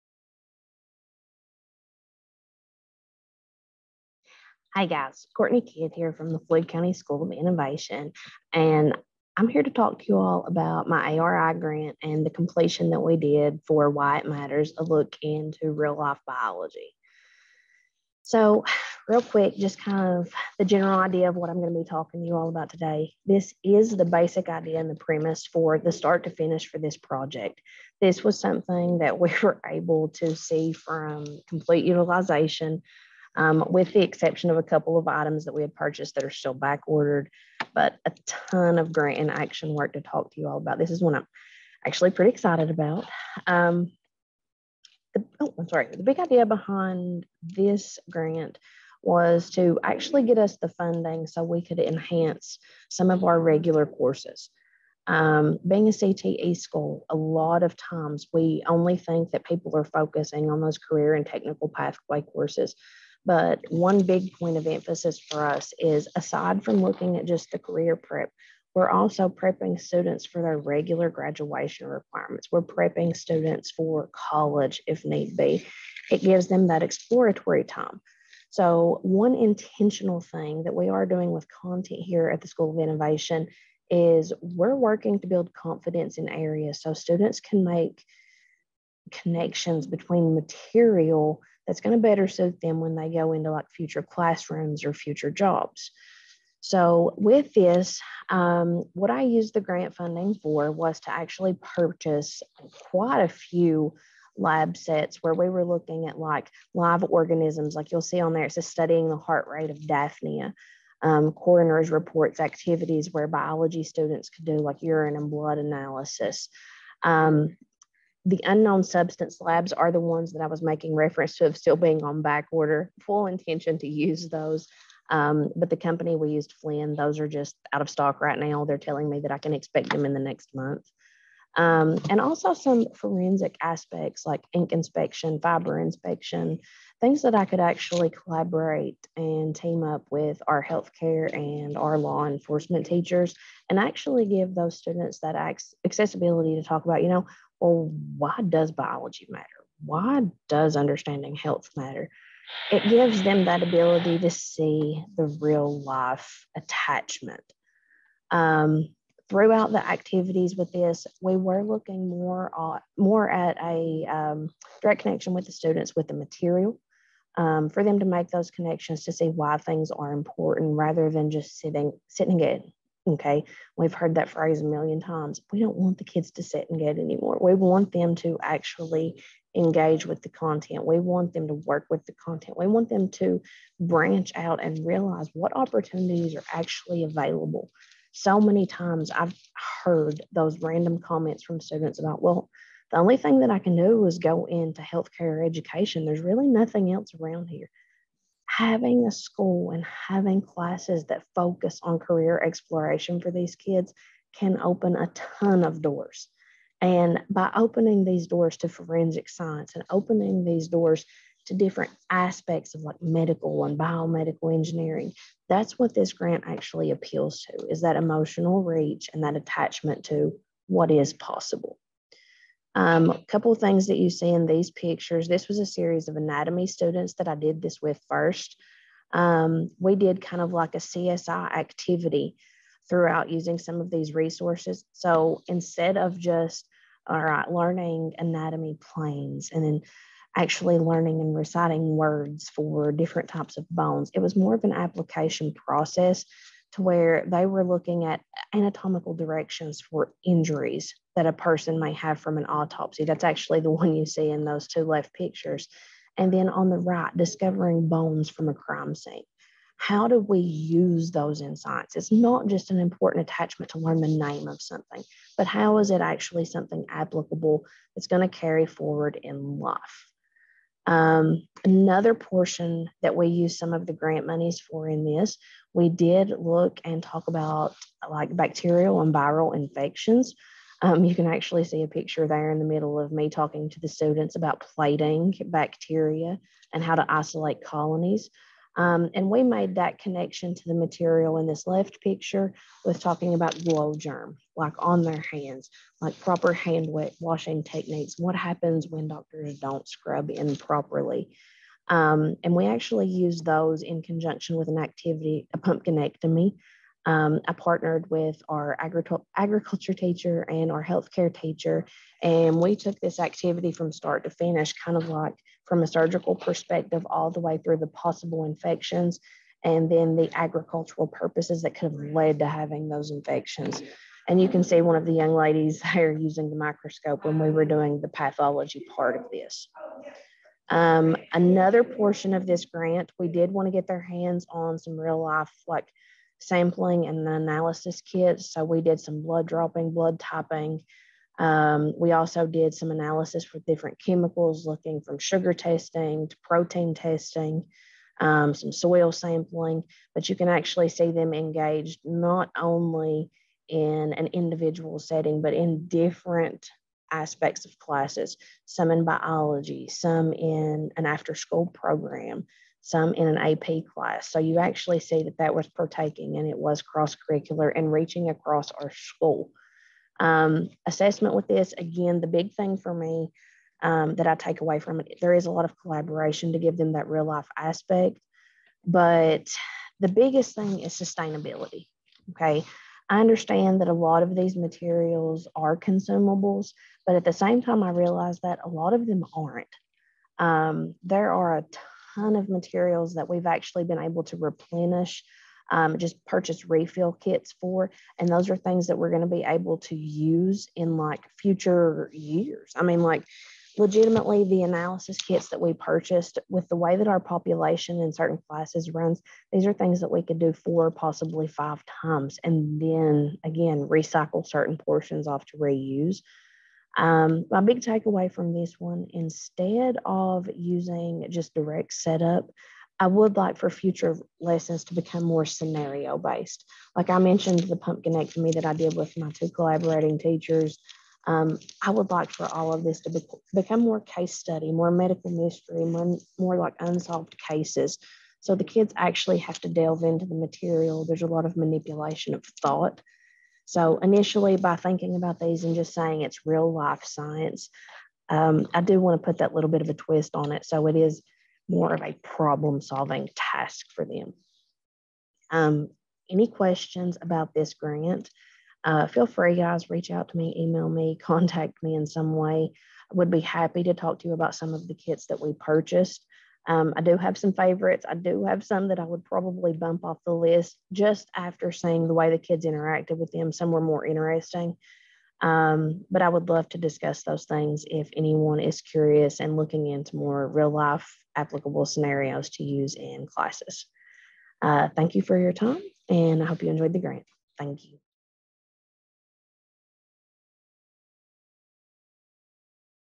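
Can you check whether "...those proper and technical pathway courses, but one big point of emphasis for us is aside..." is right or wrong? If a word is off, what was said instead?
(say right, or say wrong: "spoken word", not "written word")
wrong: "career", not "proper".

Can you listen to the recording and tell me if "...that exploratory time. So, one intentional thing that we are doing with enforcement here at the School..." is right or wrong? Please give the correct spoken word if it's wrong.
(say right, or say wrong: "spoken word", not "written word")
wrong: "content", not "enforcement".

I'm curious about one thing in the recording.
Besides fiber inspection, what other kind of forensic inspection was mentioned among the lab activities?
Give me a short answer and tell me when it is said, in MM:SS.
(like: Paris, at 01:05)
ink inspection, at 02:14.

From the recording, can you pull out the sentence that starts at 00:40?
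This is one I'm actually pretty excited about.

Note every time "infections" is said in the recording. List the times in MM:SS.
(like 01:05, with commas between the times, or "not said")
04:39, 05:18, 05:23.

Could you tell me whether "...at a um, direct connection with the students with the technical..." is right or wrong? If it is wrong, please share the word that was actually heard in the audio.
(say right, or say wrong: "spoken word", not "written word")
wrong: "material", not "technical".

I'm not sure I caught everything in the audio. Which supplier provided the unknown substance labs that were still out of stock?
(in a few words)
Flinn.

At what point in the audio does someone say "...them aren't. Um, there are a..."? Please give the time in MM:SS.
06:29.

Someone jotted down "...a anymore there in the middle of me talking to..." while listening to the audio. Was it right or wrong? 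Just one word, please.
wrong.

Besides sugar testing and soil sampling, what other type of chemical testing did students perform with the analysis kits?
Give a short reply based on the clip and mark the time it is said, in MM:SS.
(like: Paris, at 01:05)
protein testing, at 05:46.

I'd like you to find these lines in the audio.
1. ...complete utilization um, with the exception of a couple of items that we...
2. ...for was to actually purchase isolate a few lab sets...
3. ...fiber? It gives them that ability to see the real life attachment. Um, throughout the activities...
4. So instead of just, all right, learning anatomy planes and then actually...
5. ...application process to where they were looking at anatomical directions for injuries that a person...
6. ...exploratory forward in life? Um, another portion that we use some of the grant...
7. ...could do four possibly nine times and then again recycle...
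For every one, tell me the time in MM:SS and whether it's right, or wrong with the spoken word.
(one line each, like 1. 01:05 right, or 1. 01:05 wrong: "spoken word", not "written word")
1. 00:31 right
2. 01:40 wrong: "quite", not "isolate"
3. 02:31 wrong: "matter", not "fiber"
4. 03:54 right
5. 04:04 right
6. 04:28 wrong: "carry", not "exploratory"
7. 06:50 wrong: "five", not "nine".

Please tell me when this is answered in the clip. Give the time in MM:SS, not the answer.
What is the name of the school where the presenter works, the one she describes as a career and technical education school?
00:06.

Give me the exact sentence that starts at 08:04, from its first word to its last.
Uh, thank you for your time, and I hope you enjoyed the grant.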